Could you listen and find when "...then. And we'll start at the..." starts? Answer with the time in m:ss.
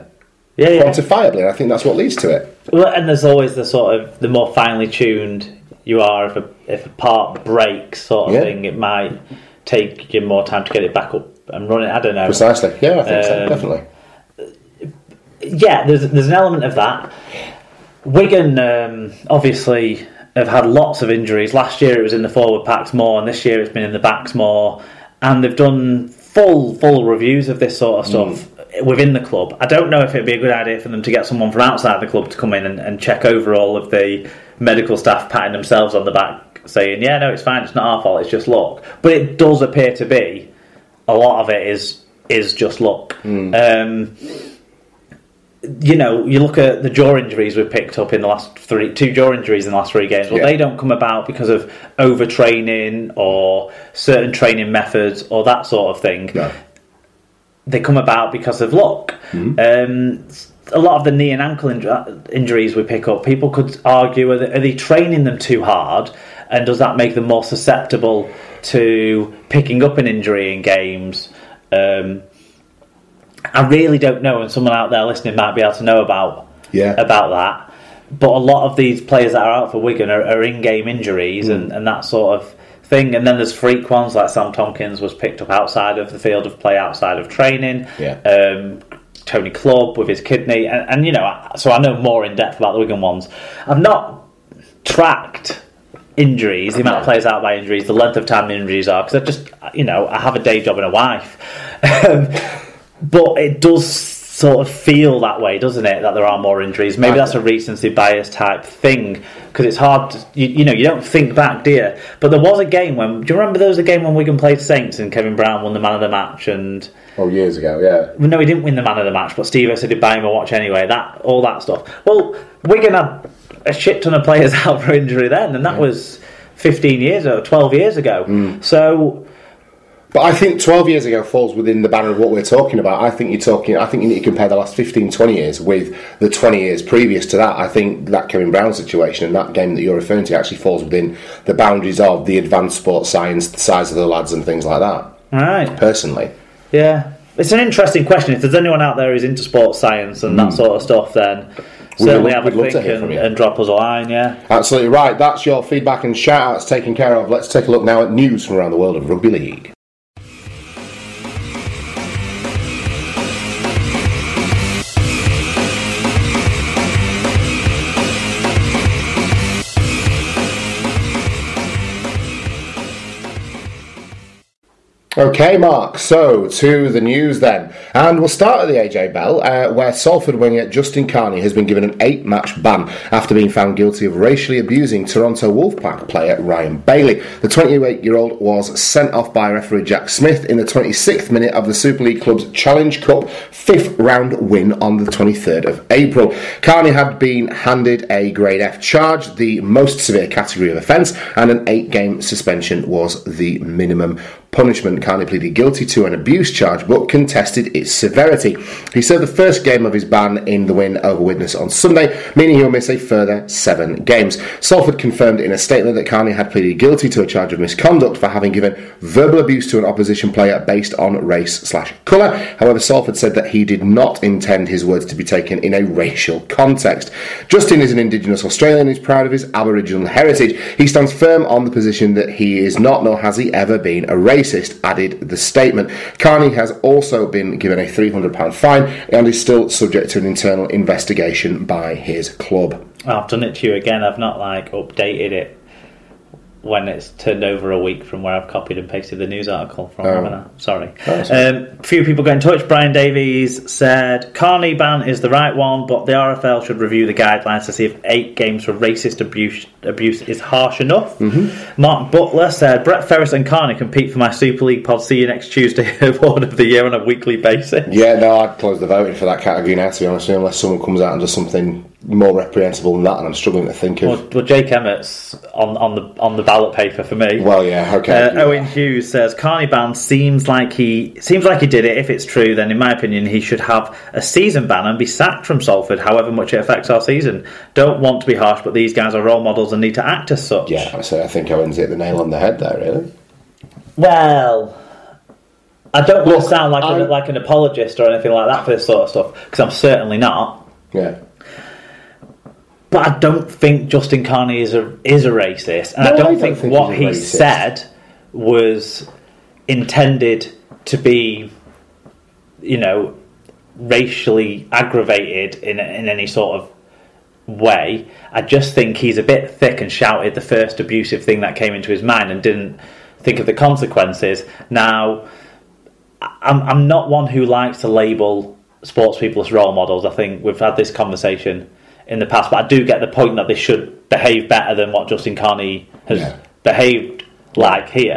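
2:57.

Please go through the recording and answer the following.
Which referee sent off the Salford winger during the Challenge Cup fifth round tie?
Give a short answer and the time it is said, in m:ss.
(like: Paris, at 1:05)
Jack Smith, at 3:09.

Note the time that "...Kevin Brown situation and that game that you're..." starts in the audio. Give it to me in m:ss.
2:18.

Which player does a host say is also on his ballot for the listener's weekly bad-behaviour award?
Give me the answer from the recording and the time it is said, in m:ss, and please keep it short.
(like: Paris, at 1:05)
Jake Emmitt, at 4:34.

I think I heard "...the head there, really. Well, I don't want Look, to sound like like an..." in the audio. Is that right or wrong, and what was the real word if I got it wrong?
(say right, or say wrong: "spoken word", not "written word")
right.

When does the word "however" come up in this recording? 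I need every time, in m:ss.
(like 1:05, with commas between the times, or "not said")
3:42, 4:45.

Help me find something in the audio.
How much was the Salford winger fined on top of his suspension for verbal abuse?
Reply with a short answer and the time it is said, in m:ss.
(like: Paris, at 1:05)
£300, at 3:57.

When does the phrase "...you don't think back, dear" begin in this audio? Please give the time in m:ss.
1:50.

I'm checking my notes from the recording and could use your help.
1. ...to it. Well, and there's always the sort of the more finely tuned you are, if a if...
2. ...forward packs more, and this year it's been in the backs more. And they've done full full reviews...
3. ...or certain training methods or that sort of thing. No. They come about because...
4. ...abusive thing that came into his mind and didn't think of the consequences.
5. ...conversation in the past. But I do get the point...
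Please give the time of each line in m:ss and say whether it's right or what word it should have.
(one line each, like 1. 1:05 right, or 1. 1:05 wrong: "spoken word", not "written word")
1. 0:02 right
2. 0:22 right
3. 0:53 right
4. 5:20 right
5. 5:30 right.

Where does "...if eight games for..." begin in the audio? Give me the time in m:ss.
4:17.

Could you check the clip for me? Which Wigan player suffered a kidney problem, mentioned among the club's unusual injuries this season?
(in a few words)
Tony Clubb.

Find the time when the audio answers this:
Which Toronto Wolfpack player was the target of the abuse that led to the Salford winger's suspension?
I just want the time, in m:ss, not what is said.
3:06.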